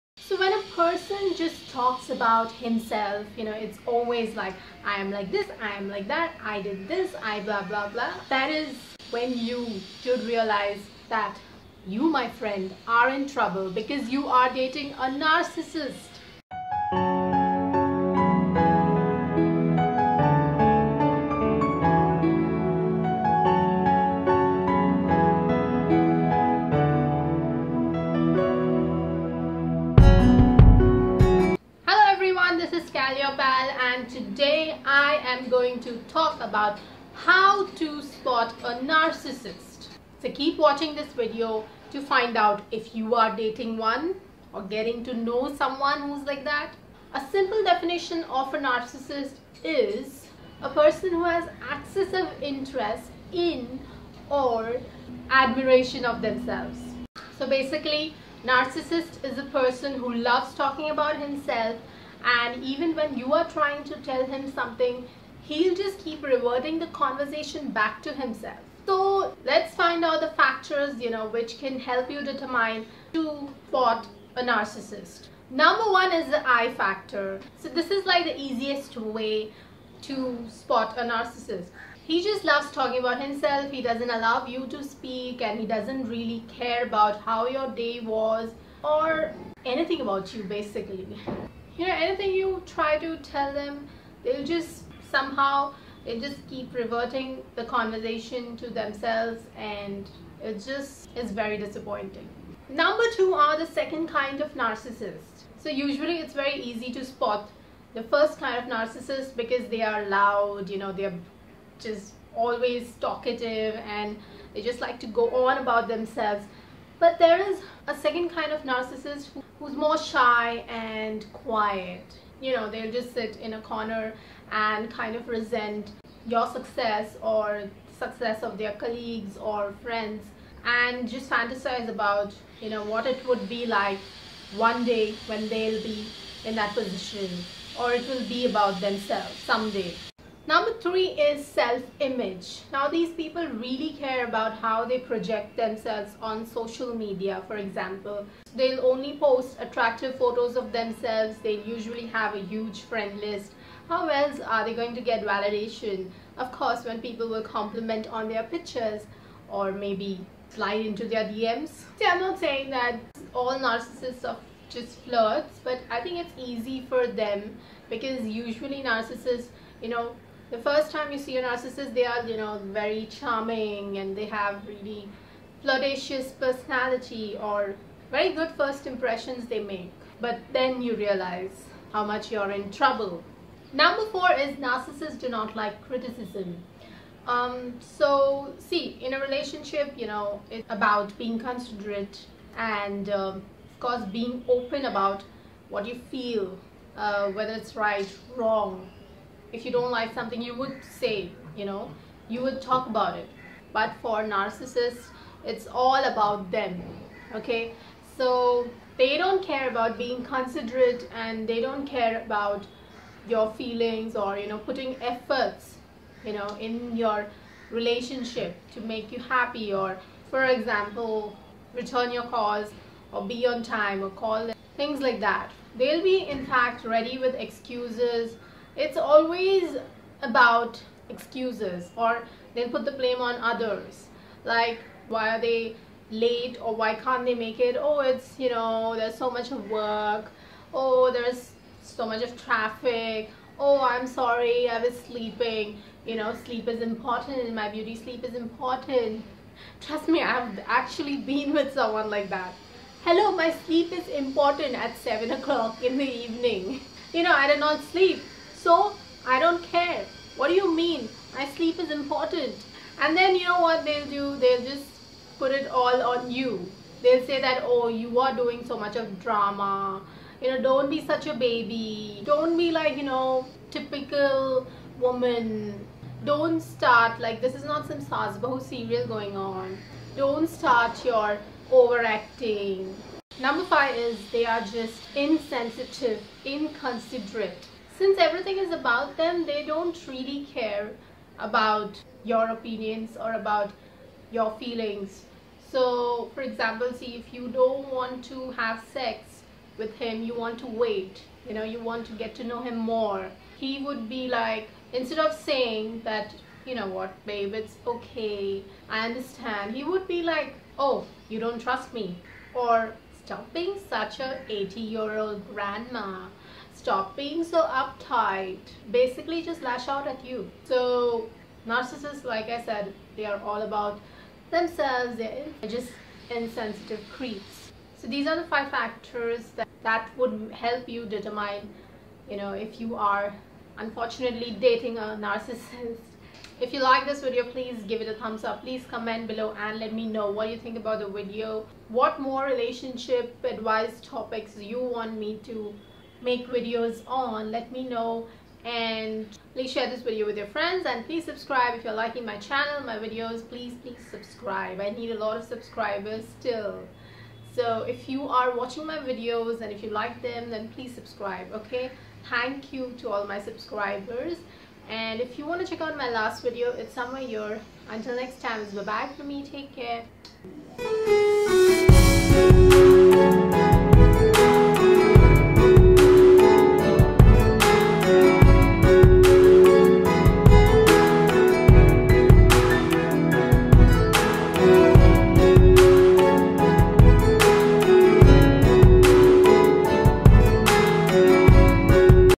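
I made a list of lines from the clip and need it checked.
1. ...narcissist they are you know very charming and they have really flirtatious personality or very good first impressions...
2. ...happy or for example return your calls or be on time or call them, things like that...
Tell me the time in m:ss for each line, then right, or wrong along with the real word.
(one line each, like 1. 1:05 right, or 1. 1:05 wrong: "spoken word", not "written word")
1. 2:51 right
2. 3:39 right.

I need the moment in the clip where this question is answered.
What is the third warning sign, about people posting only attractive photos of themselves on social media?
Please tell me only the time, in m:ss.
2:21.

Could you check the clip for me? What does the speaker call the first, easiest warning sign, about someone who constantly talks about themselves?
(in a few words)
the I factor.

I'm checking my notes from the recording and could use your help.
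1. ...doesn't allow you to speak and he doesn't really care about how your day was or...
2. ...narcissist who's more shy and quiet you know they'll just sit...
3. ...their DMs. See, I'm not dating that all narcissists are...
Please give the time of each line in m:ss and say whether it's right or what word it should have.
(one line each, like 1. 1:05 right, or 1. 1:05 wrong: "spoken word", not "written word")
1. 1:23 right
2. 1:58 right
3. 2:41 wrong: "saying", not "dating".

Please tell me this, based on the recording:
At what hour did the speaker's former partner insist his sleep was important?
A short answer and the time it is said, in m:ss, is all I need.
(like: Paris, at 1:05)
7 o'clock, at 4:14.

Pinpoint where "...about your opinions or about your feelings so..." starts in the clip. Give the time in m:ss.
4:51.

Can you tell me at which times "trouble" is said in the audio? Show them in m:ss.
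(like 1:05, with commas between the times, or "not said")
0:13, 3:02.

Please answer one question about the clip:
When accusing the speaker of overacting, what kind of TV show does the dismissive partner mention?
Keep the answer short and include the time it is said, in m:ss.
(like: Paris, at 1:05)
saas-bahu serial, at 4:38.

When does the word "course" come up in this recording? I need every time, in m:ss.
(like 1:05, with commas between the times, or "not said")
2:36, 3:13.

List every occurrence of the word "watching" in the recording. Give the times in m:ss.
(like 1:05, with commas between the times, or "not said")
0:40, 5:58.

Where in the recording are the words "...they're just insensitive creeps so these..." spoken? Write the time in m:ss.
5:25.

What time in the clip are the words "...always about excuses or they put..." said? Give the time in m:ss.
3:48.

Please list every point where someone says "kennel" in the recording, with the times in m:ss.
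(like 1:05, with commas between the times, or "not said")
not said.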